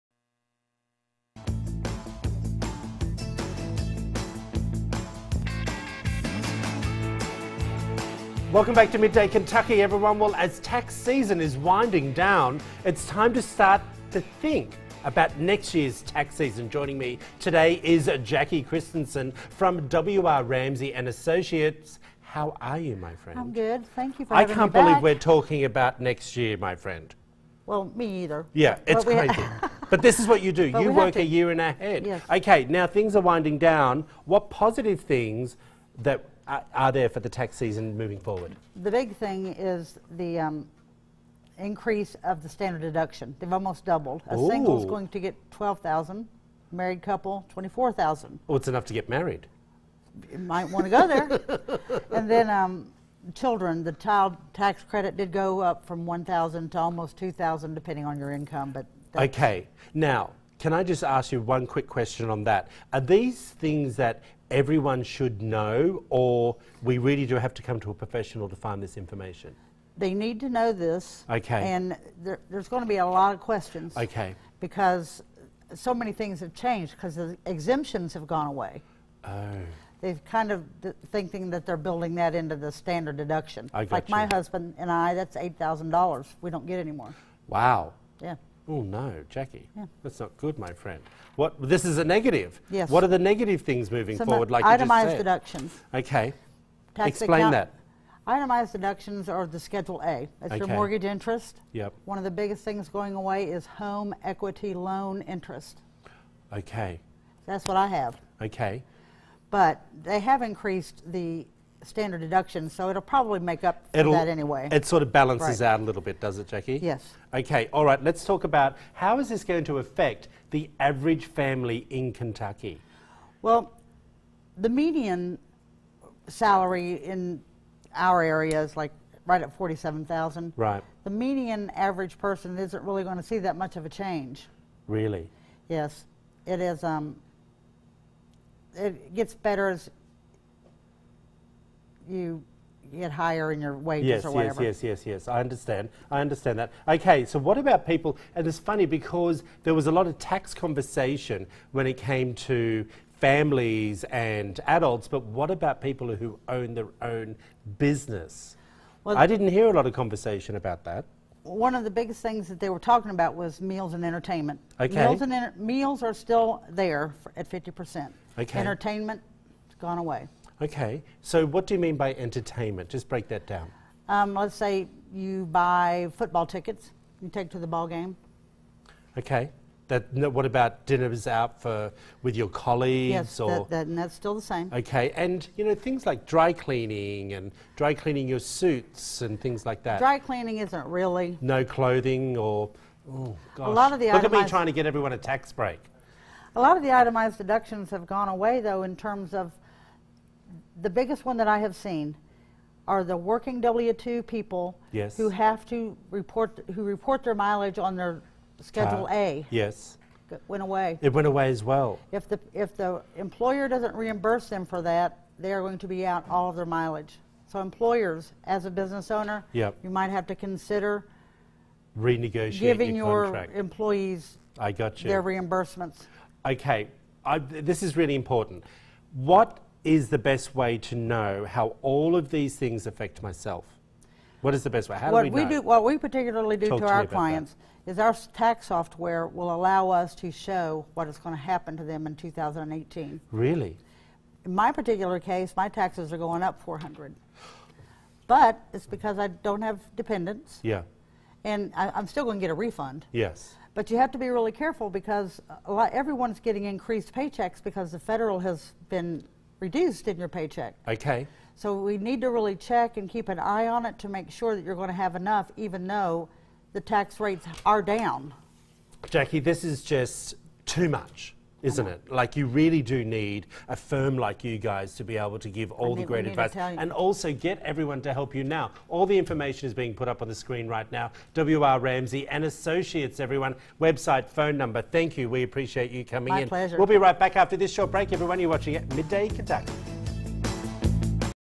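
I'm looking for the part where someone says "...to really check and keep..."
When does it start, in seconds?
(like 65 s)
262 s.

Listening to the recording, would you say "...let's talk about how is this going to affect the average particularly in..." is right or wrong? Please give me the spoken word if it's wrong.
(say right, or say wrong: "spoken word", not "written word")
wrong: "family", not "particularly".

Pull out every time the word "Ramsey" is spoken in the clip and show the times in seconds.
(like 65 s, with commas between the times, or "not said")
20 s, 281 s.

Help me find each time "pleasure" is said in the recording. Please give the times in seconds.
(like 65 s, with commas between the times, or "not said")
286 s.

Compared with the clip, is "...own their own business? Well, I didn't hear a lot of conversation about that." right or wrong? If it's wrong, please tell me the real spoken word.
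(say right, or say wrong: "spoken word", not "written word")
right.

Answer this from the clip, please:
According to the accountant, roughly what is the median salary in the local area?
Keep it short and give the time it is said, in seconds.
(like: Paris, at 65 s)
47,000, at 129 s.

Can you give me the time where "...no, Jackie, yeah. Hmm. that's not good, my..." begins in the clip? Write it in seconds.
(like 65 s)
88 s.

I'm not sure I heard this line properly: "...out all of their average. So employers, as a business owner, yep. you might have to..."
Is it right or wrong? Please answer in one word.
wrong.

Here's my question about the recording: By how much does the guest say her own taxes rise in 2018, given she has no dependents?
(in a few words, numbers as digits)
400.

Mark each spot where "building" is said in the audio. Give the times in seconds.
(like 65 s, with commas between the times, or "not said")
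81 s.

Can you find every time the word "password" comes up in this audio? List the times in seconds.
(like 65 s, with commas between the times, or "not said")
not said.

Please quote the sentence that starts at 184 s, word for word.
Okay, and you know things like dry cleaning and dry cleaning your suits and things like that.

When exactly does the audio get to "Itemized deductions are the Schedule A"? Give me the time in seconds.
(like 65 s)
98 s.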